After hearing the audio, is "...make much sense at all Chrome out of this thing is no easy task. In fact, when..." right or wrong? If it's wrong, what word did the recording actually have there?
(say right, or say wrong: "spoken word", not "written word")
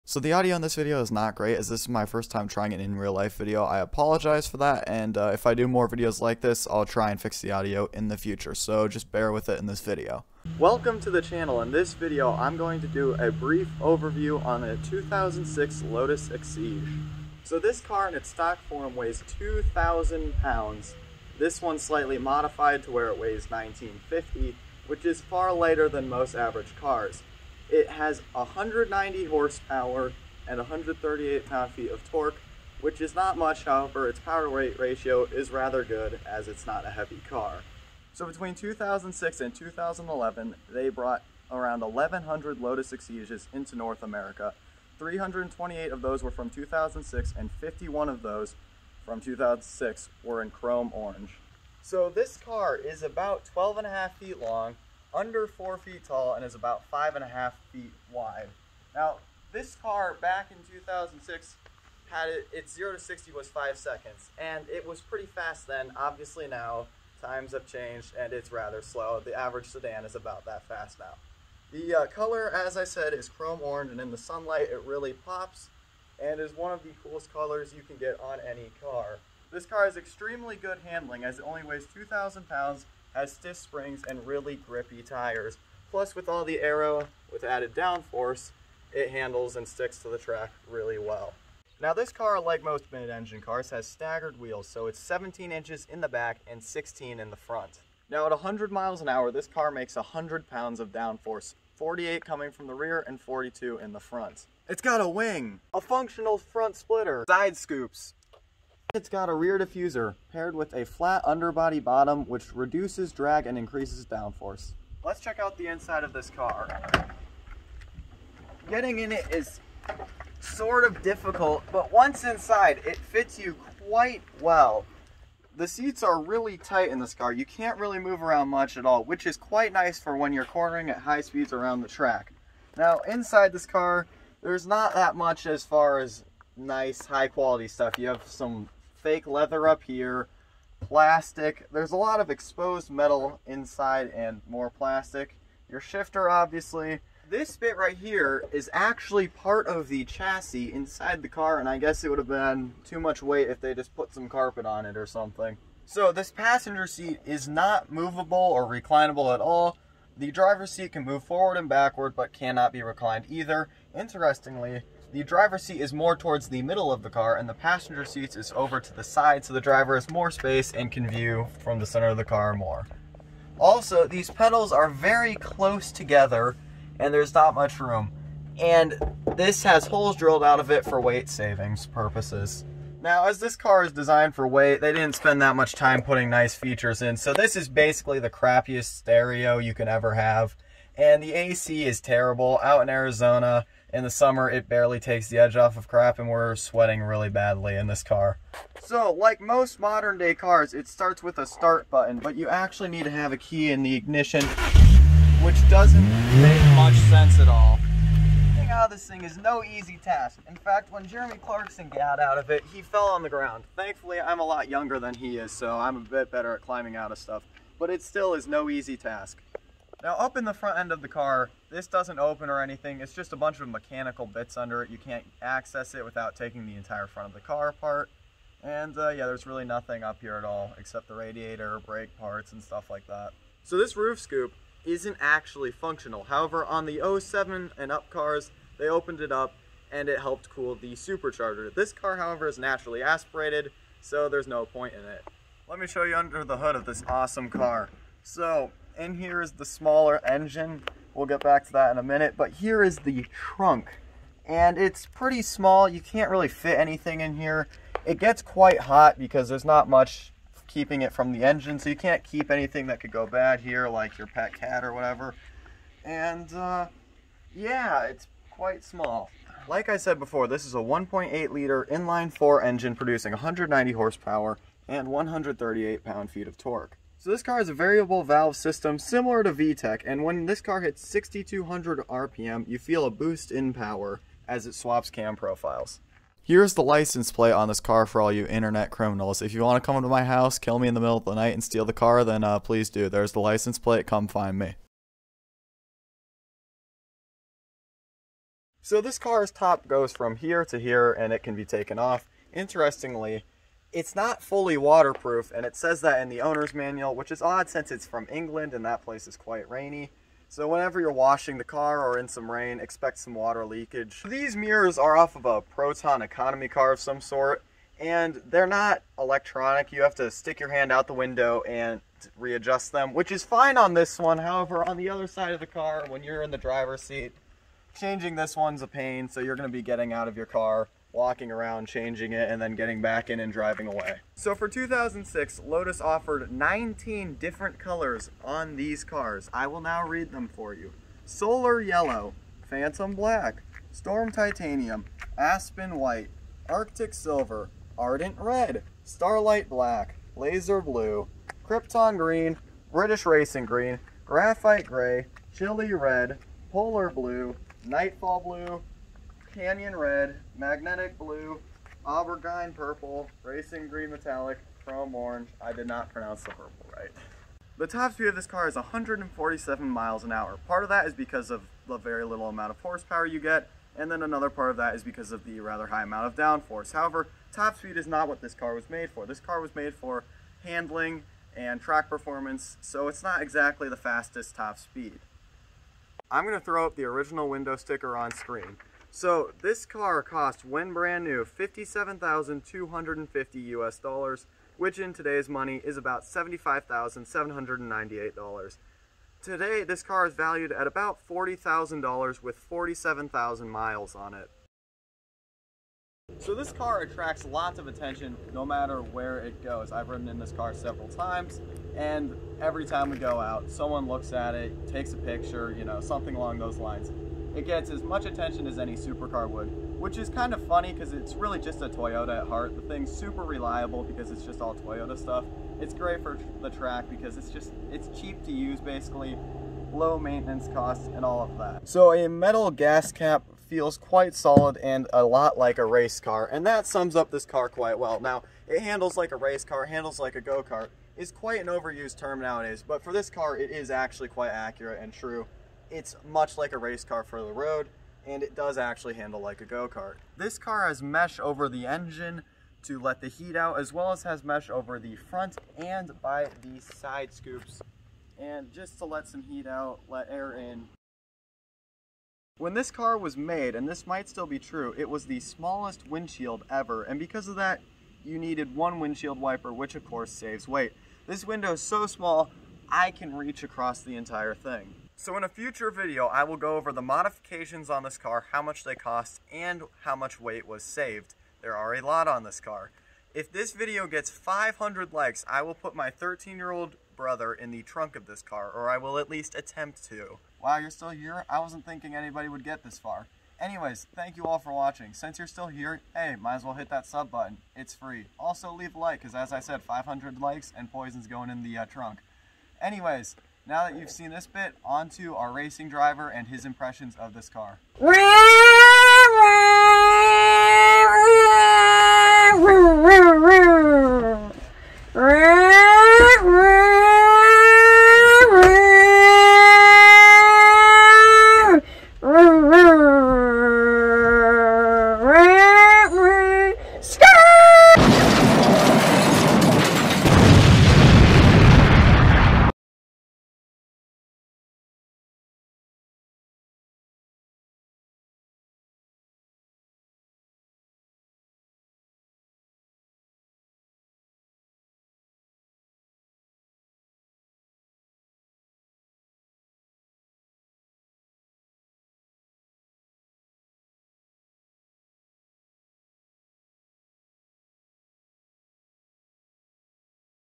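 wrong: "Getting", not "Chrome".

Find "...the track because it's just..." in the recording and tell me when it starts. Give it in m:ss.
7:06.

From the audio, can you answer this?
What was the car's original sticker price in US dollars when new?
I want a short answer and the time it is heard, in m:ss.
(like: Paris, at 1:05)
$57,250, at 6:31.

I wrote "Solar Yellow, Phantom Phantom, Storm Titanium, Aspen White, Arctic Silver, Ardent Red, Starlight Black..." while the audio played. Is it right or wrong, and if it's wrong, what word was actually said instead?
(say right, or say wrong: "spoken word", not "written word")
wrong: "Black", not "Phantom".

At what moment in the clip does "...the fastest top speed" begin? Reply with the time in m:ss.
6:23.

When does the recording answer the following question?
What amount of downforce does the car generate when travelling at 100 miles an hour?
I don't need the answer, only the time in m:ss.
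1:39.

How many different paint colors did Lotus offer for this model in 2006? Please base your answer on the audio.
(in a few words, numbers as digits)
19.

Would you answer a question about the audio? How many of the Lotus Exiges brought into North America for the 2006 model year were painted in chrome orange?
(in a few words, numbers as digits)
51.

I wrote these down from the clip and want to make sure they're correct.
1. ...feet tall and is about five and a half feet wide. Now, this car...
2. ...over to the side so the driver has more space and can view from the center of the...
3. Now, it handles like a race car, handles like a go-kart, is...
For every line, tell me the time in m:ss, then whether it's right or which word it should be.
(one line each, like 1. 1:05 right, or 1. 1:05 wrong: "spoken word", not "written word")
1. 0:55 right
2. 2:48 right
3. 7:18 right.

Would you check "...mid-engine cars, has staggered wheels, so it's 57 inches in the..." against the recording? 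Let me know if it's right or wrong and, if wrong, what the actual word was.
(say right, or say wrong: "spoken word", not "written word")
wrong: "17", not "57".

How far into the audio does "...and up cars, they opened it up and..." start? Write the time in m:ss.
3:57.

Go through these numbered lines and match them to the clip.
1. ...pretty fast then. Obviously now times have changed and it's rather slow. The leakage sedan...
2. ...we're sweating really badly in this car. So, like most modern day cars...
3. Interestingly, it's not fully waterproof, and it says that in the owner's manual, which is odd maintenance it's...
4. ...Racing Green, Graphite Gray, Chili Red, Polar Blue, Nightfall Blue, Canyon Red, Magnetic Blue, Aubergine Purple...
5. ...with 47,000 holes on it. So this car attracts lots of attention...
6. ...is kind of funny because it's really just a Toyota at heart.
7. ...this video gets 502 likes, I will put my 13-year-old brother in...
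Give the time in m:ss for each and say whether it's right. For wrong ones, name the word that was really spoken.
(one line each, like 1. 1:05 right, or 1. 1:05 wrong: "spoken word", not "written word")
1. 1:05 wrong: "average", not "leakage"
2. 3:16 right
3. 5:02 wrong: "since", not "maintenance"
4. 5:53 right
5. 6:42 wrong: "miles", not "holes"
6. 7:00 right
7. 8:03 wrong: "500", not "502".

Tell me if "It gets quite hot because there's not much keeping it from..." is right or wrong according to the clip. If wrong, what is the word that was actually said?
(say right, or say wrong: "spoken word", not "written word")
right.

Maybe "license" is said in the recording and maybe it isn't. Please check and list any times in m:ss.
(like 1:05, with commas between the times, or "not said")
4:46, 4:53.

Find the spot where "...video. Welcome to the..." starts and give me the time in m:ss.
0:09.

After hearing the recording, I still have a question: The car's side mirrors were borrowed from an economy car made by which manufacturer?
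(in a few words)
Proton.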